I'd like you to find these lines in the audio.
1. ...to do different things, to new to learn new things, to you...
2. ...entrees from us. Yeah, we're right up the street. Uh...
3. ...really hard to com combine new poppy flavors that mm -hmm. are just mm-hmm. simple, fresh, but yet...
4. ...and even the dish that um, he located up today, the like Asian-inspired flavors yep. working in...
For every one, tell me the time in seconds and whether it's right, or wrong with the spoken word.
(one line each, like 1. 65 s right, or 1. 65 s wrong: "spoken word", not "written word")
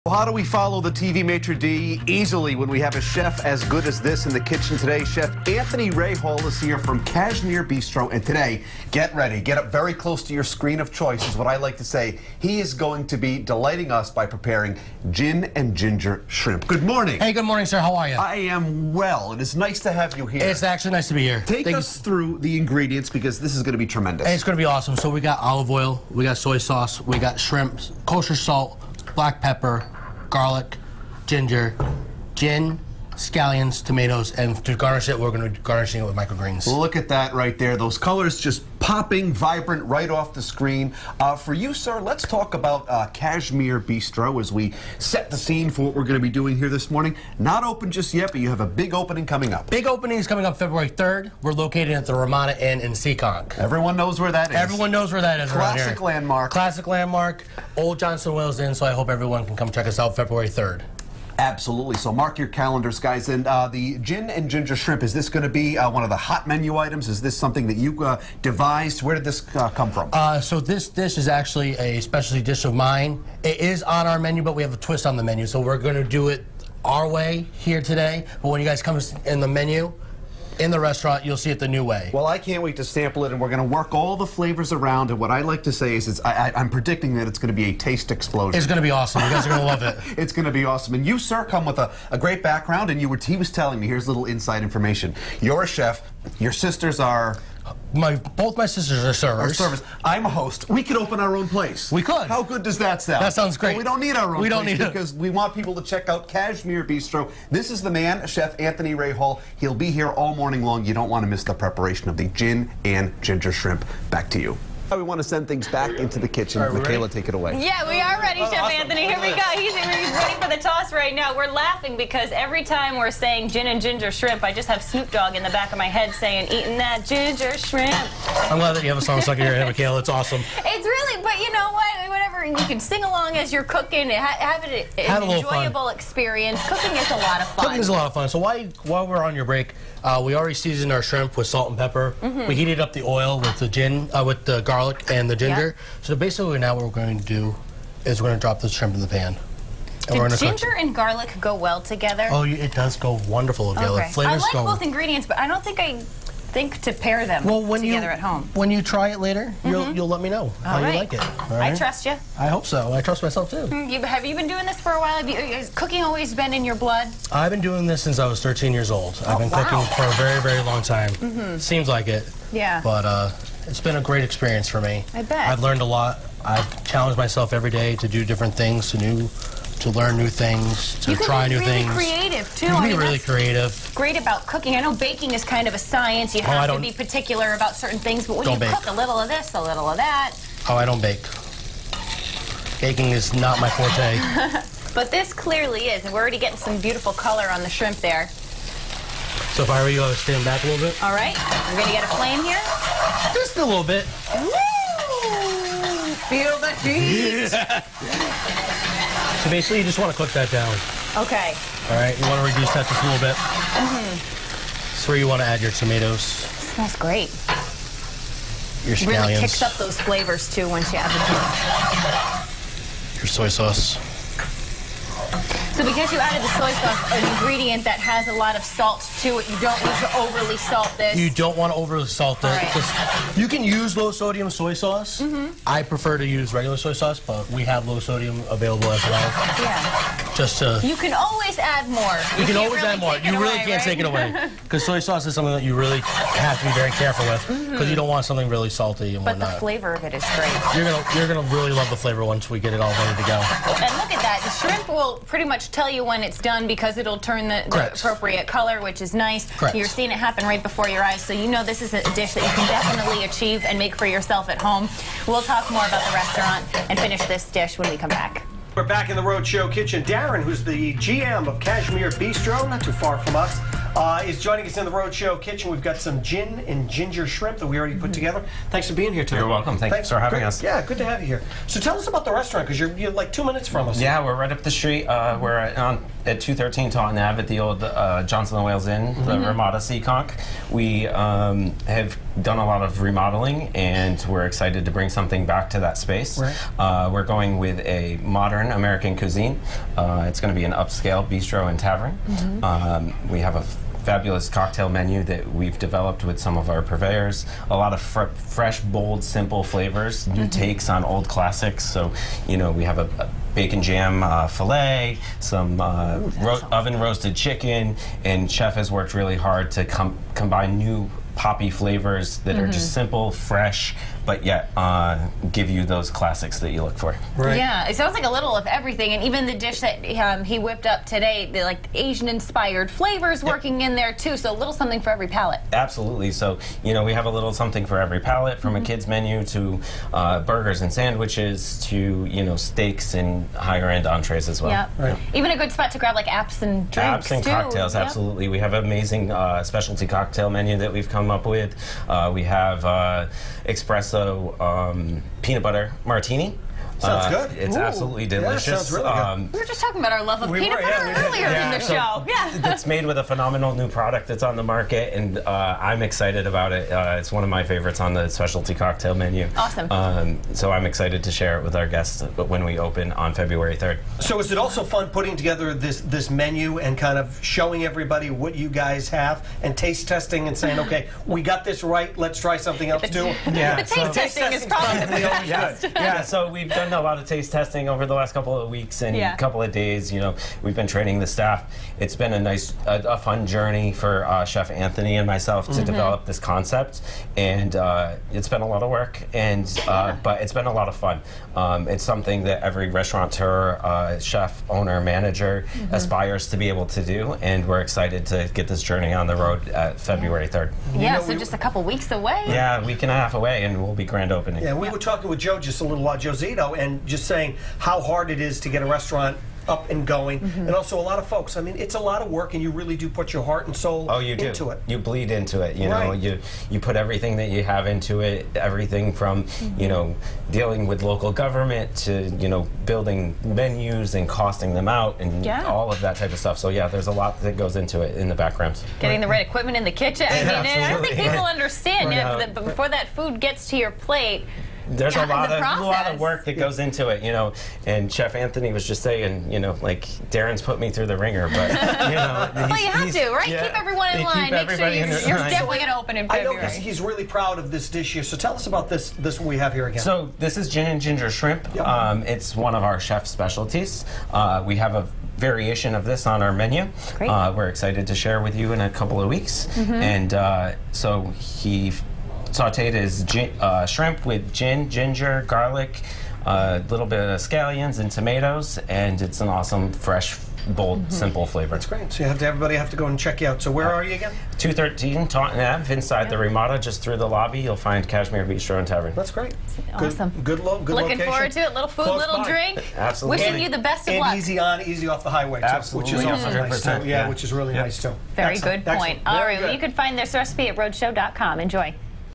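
1. 178 s right
2. 283 s wrong: "minutes", not "entrees"
3. 319 s right
4. 329 s wrong: "whipped", not "located".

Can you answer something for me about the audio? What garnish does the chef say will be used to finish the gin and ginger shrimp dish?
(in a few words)
Microgreens.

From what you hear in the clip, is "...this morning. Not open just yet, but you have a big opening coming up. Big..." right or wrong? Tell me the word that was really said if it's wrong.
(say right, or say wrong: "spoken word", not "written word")
right.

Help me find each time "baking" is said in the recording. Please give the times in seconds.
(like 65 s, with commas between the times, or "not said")
184 s, 192 s.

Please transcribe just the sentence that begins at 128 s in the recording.
I'm glad that you have a song stuck in your head, Michaela.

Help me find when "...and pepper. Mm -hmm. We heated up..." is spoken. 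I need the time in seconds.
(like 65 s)
141 s.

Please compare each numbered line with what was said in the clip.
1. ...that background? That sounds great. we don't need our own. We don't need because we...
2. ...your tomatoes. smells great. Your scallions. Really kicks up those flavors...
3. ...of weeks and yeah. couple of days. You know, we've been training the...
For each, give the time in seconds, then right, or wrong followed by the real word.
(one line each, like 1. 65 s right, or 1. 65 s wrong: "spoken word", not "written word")
1. 102 s wrong: "sound", not "background"
2. 215 s right
3. 388 s right.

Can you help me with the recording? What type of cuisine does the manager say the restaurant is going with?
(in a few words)
Modern American.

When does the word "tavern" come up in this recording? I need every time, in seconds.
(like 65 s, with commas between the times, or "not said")
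301 s, 488 s.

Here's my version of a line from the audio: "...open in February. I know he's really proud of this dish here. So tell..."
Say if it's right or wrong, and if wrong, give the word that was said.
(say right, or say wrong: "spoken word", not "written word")
right.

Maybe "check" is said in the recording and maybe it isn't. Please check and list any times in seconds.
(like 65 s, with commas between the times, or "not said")
59 s, 105 s, 483 s.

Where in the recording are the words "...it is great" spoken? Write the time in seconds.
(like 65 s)
250 s.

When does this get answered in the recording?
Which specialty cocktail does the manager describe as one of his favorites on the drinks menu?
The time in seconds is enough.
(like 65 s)
355 s.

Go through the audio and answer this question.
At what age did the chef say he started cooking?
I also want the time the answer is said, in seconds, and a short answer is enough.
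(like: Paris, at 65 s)
13, at 168 s.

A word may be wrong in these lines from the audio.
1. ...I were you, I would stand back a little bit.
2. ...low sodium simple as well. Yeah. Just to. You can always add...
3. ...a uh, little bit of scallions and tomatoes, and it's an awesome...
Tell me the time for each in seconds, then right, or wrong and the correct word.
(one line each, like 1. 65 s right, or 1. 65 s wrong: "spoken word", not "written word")
1. 199 s right
2. 237 s wrong: "available", not "simple"
3. 476 s right.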